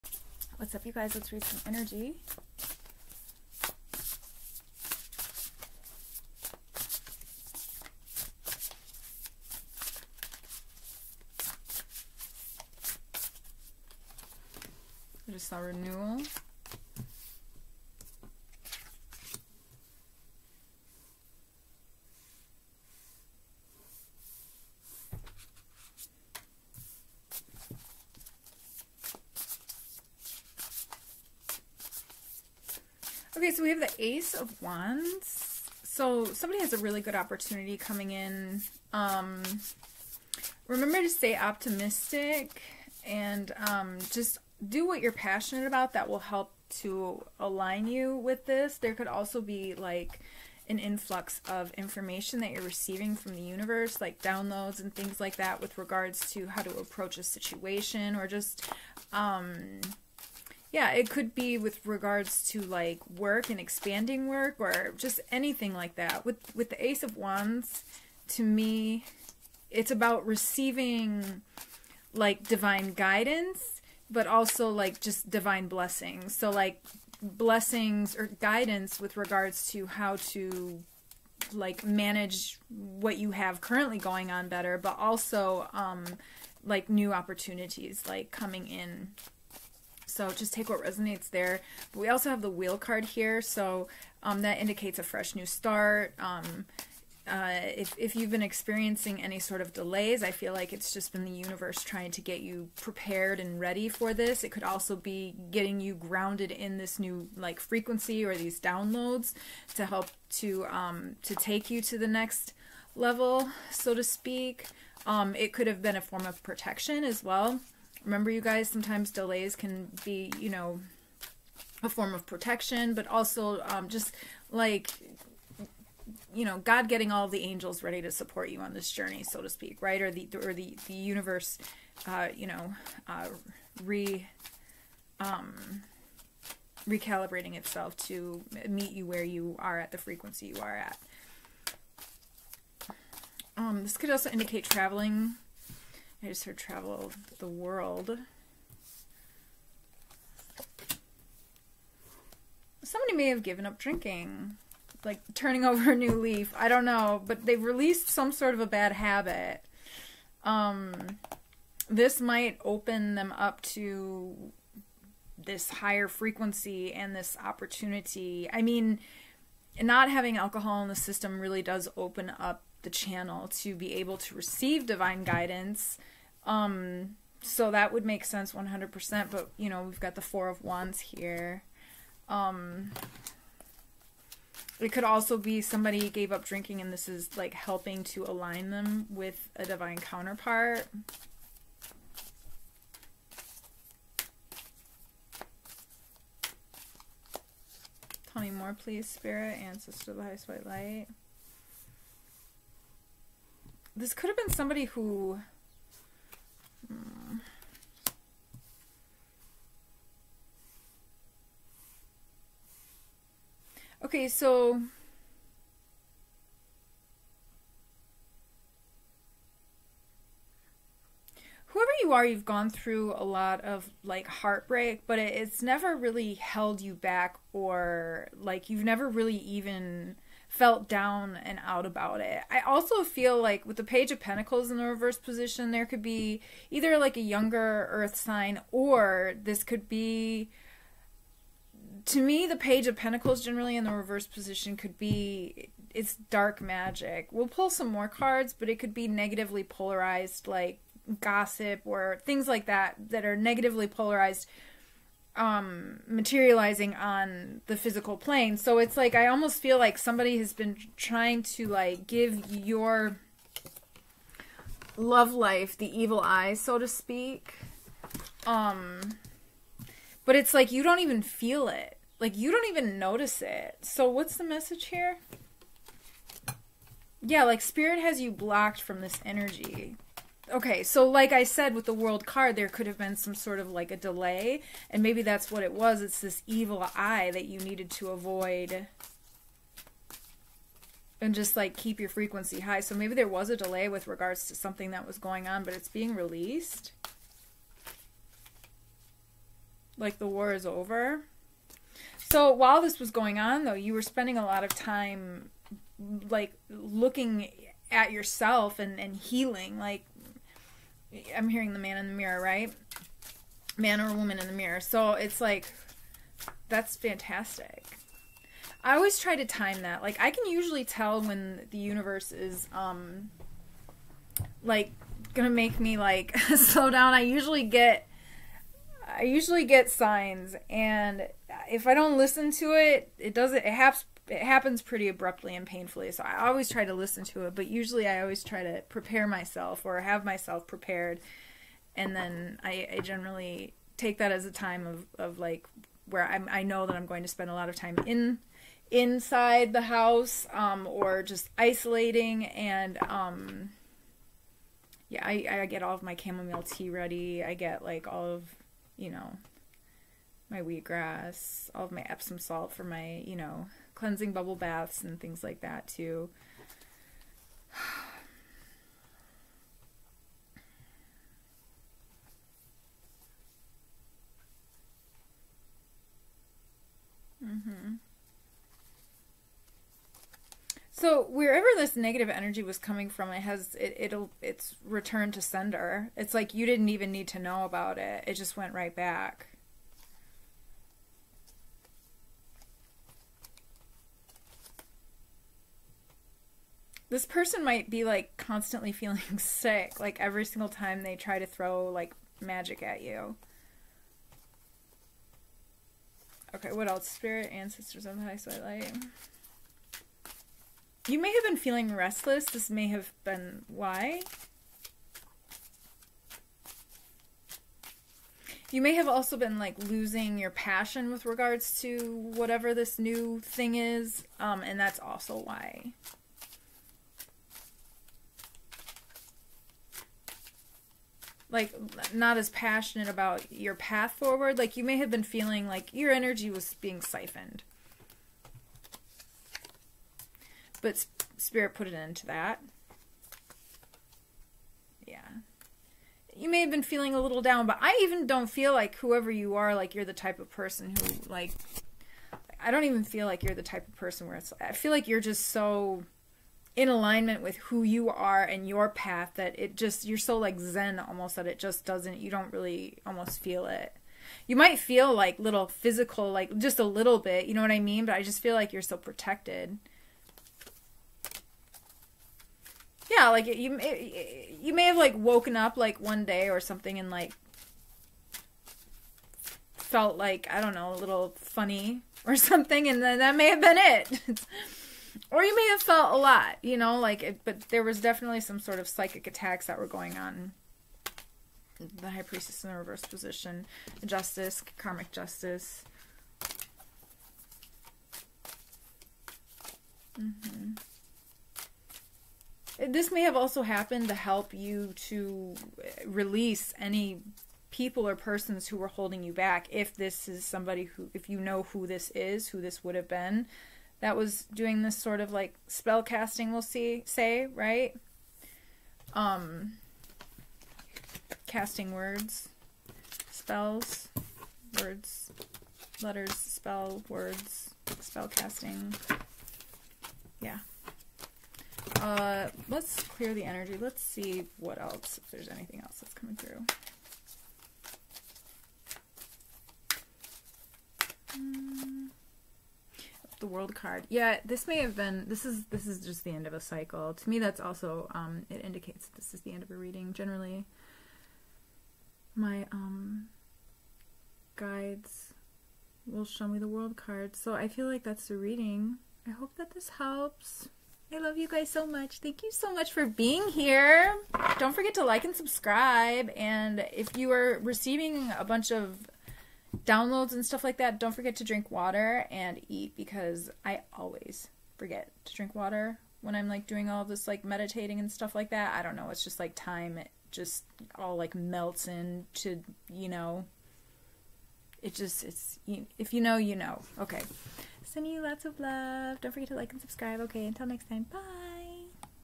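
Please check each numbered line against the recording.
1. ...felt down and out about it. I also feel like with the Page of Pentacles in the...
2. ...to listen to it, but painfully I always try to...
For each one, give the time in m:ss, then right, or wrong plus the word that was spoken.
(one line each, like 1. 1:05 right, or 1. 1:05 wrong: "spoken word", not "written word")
1. 3:50 right
2. 5:36 wrong: "usually", not "painfully".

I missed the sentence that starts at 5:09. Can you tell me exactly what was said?
Like I'm hearing the man in the mirror, right?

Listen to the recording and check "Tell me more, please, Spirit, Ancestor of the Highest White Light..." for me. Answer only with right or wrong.
right.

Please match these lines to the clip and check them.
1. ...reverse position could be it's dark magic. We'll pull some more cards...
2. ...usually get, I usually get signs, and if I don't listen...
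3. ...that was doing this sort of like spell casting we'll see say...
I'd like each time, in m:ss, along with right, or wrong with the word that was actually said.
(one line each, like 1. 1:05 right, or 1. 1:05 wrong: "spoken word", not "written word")
1. 4:03 right
2. 5:27 right
3. 8:34 right.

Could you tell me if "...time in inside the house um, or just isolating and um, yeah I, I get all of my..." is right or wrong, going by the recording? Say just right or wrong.
right.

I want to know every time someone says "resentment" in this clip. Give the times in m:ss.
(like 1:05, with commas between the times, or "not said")
not said.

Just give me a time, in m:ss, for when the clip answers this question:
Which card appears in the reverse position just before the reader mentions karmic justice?
8:12.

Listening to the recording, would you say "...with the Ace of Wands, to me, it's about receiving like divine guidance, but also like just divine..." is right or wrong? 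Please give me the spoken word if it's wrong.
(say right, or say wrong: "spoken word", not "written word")
right.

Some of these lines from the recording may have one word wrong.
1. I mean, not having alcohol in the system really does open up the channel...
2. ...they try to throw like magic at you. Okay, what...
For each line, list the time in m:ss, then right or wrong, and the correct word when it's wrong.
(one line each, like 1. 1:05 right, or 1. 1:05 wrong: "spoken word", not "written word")
1. 2:48 right
2. 6:41 right.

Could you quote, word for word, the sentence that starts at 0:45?
That will help to align you with this.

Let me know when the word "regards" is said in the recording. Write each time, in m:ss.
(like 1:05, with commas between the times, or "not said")
0:55, 1:01, 1:19, 4:54, 7:01.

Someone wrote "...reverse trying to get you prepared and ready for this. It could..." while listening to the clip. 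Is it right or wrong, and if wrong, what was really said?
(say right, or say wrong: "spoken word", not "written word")
wrong: "universe", not "reverse".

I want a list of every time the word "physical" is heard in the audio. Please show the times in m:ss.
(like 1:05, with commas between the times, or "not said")
4:17, 7:45.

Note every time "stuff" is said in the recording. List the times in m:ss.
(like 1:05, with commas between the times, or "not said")
9:30, 9:38.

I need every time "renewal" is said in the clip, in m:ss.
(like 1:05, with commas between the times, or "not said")
0:15.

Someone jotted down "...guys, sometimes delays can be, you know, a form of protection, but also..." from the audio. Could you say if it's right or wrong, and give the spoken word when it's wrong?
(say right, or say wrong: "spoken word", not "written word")
right.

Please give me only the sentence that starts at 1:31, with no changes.
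But we also have the world card here.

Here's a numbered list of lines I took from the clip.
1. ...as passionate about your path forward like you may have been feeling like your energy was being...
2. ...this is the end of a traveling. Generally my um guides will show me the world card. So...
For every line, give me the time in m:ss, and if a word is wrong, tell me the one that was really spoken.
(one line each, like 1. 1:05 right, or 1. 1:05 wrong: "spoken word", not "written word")
1. 7:12 right
2. 9:09 wrong: "reading", not "traveling".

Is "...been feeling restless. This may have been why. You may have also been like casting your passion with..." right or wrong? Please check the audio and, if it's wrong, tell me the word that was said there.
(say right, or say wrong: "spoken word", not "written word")
wrong: "losing", not "casting".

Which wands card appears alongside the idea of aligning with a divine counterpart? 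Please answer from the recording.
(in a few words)
4 of Wands.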